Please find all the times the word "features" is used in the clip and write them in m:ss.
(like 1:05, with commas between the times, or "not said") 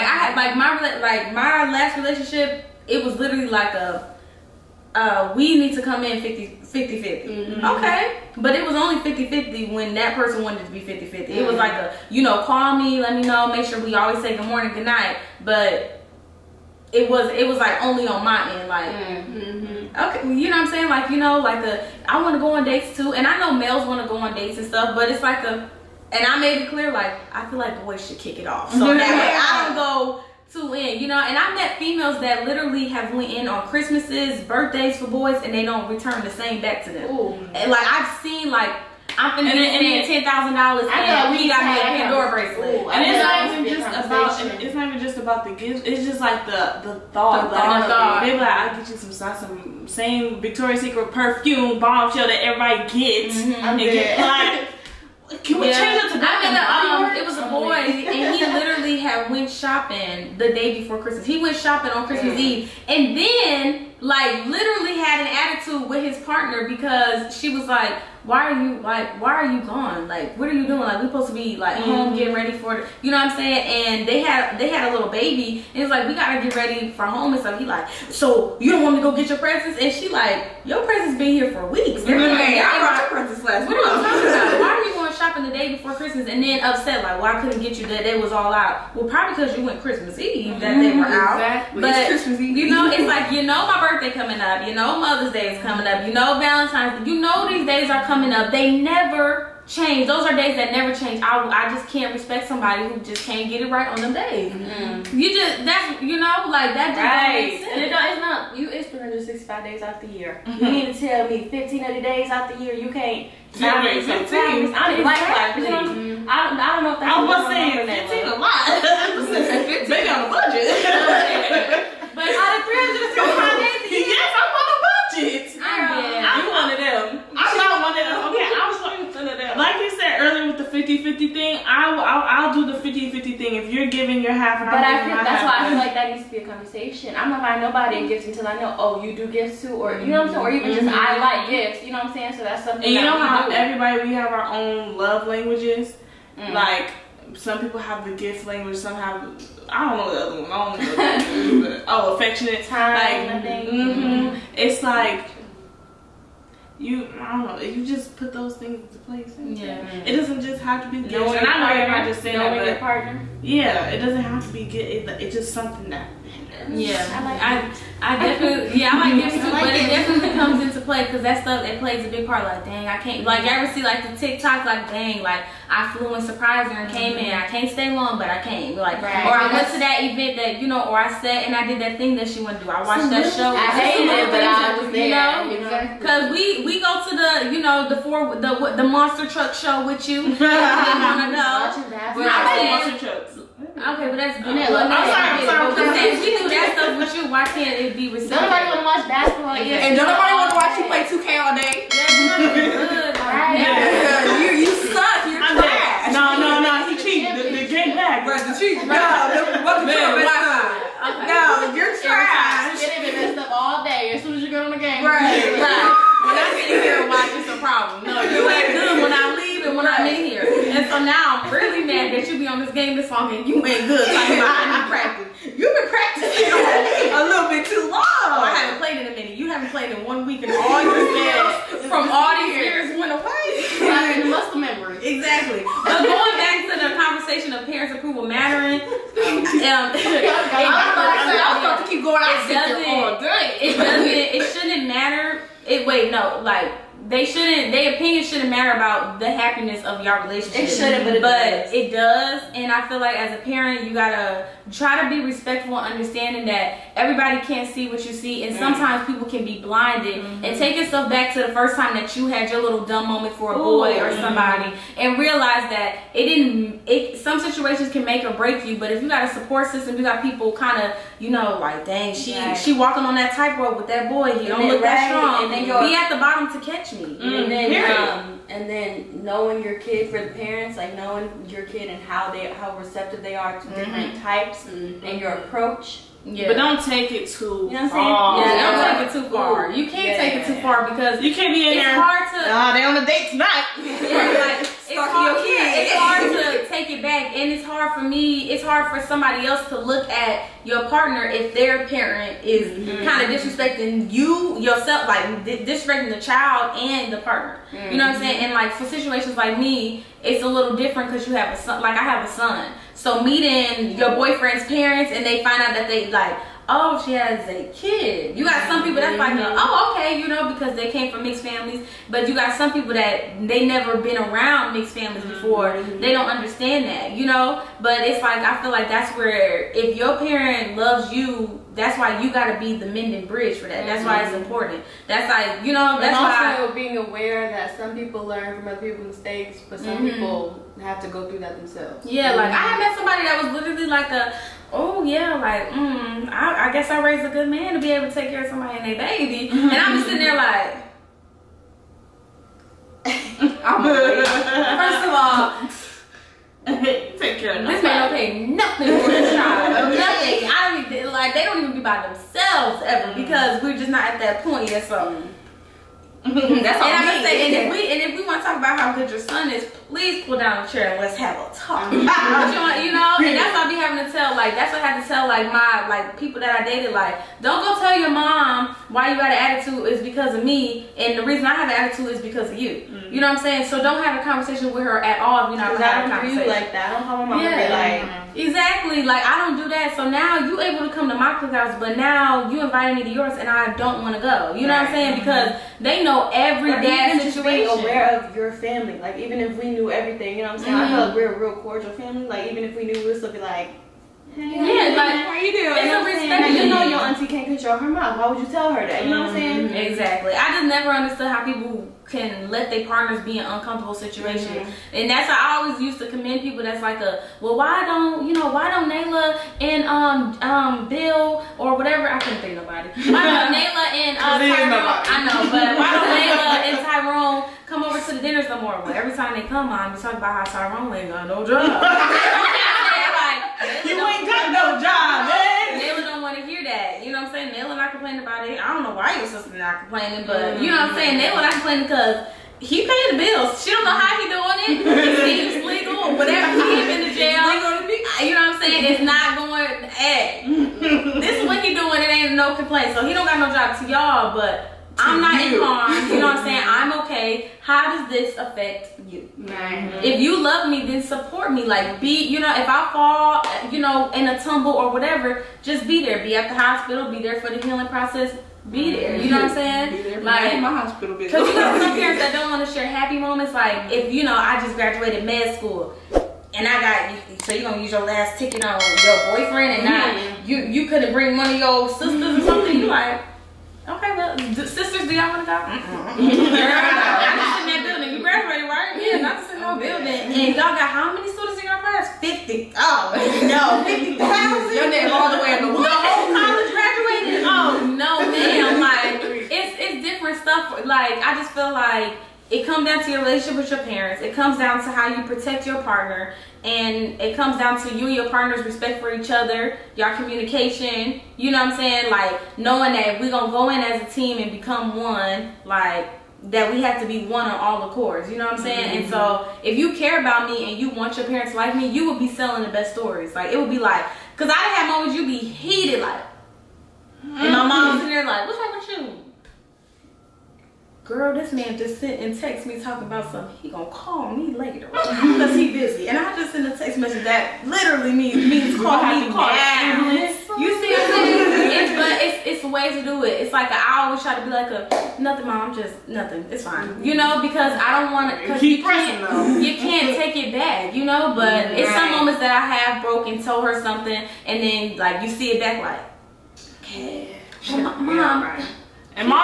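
not said.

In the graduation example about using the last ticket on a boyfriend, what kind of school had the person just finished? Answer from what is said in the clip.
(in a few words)
Med school.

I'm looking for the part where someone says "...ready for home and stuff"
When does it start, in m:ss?
1:16.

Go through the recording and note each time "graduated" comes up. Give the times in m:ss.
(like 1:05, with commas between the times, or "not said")
7:54, 8:08, 8:16.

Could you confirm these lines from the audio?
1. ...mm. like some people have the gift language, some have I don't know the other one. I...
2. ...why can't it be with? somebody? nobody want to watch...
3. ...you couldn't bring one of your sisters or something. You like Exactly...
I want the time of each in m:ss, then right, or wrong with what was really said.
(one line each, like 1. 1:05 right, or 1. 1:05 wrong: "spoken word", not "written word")
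1. 2:26 right
2. 3:17 right
3. 8:00 wrong: "Okay", not "Exactly".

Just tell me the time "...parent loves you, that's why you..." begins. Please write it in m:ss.
5:30.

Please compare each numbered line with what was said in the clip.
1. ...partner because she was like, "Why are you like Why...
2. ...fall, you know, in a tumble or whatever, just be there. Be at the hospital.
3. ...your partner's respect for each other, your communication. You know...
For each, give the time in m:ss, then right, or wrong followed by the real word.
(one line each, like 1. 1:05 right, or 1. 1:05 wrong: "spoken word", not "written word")
1. 1:06 right
2. 7:42 right
3. 8:28 right.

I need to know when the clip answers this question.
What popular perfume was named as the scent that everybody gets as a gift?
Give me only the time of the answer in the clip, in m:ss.
0:51.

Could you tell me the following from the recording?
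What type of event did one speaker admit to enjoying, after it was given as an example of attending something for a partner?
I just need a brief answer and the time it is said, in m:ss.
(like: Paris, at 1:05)
Monster truck show, at 3:08.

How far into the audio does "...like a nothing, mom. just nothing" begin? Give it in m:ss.
9:04.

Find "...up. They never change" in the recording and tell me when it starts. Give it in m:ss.
1:38.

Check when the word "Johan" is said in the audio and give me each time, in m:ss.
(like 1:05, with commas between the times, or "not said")
not said.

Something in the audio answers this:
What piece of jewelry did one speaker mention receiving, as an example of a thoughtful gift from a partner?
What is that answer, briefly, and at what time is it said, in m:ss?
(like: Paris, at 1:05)
Pandora bracelet, at 0:42.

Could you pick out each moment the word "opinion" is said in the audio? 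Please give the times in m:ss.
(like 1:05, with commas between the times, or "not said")
4:07.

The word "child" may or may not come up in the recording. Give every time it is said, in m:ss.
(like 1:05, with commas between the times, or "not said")
5:06, 5:59.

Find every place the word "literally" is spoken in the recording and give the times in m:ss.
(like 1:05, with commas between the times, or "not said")
0:03, 0:32, 0:58, 1:04, 5:43, 8:57.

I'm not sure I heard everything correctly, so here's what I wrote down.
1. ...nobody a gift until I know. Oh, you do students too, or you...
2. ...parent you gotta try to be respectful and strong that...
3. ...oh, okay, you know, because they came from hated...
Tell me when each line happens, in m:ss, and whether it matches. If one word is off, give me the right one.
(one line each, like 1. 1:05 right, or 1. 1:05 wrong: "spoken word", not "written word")
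1. 2:17 wrong: "gifts", not "students"
2. 4:13 wrong: "understanding", not "strong"
3. 5:19 wrong: "mixed", not "hated".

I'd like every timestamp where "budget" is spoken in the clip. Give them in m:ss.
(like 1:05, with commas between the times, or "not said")
2:00, 2:04.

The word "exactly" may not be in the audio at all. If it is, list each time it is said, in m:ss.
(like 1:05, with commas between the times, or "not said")
1:31, 3:28, 3:55, 6:28, 6:49.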